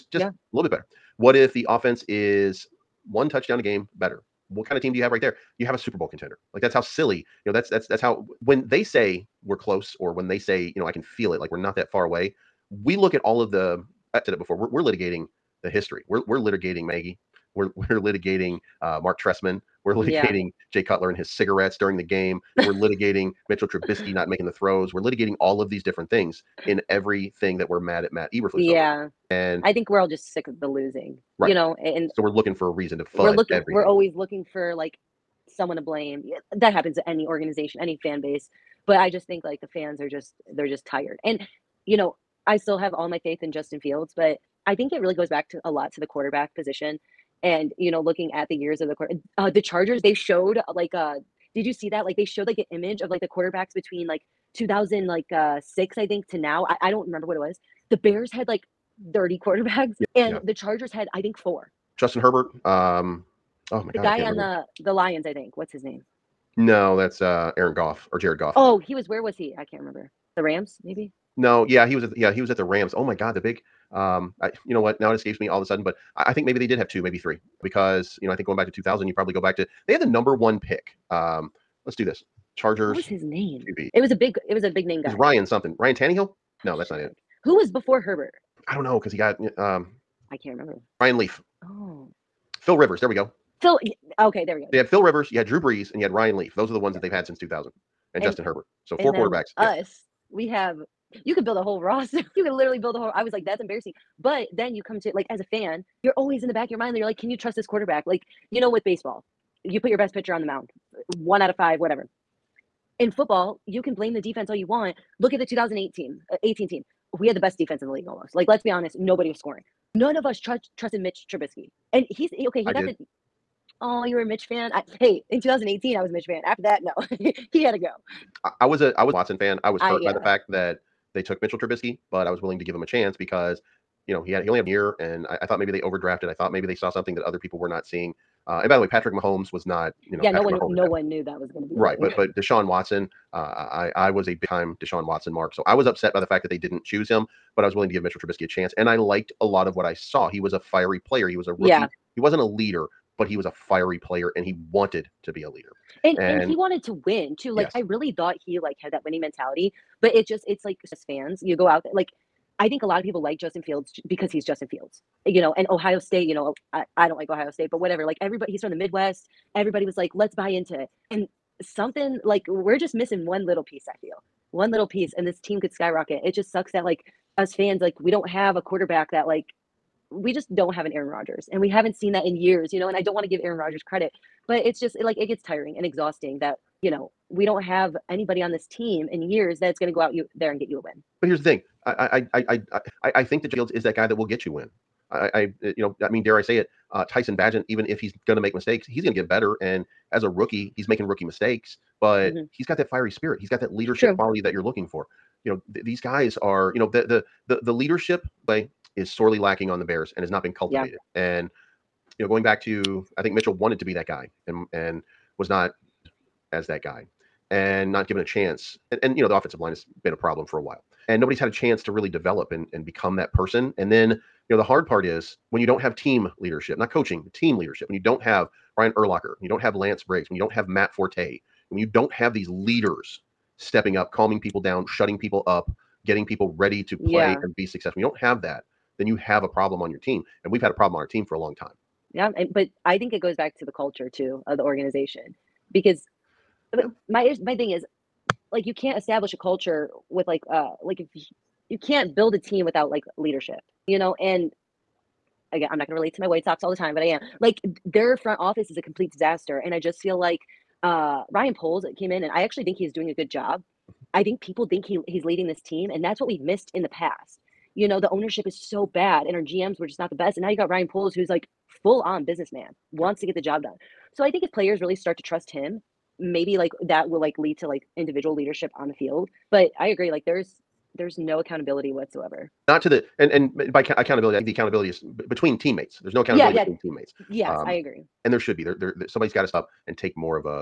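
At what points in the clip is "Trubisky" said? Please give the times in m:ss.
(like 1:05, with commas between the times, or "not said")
0:23, 2:01, 2:11, 2:28.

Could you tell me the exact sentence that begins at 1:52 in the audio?
In football, you can blame the defense all you want.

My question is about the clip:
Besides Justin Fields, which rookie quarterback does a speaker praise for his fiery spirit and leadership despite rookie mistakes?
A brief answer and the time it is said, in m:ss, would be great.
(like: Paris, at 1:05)
Tyson Bagent, at 3:17.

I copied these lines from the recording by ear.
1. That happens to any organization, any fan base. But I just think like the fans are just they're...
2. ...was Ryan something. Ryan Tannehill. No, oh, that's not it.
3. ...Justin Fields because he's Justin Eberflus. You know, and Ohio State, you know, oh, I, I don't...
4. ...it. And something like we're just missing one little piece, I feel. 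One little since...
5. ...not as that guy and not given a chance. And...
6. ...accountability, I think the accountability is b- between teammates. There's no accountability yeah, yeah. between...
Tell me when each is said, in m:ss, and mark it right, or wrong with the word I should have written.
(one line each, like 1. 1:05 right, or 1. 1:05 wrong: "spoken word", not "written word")
1. 0:36 right
2. 1:25 right
3. 2:43 wrong: "Fields", not "Eberflus"
4. 2:50 wrong: "piece", not "since"
5. 3:35 right
6. 4:43 right.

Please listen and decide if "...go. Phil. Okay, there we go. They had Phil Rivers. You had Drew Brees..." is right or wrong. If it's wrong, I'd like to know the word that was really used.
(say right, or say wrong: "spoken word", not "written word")
right.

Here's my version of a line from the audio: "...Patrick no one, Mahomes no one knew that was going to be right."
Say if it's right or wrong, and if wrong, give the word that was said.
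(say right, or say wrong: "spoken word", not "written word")
right.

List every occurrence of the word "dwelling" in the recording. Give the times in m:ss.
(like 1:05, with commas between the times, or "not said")
not said.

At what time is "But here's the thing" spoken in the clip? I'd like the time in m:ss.
3:11.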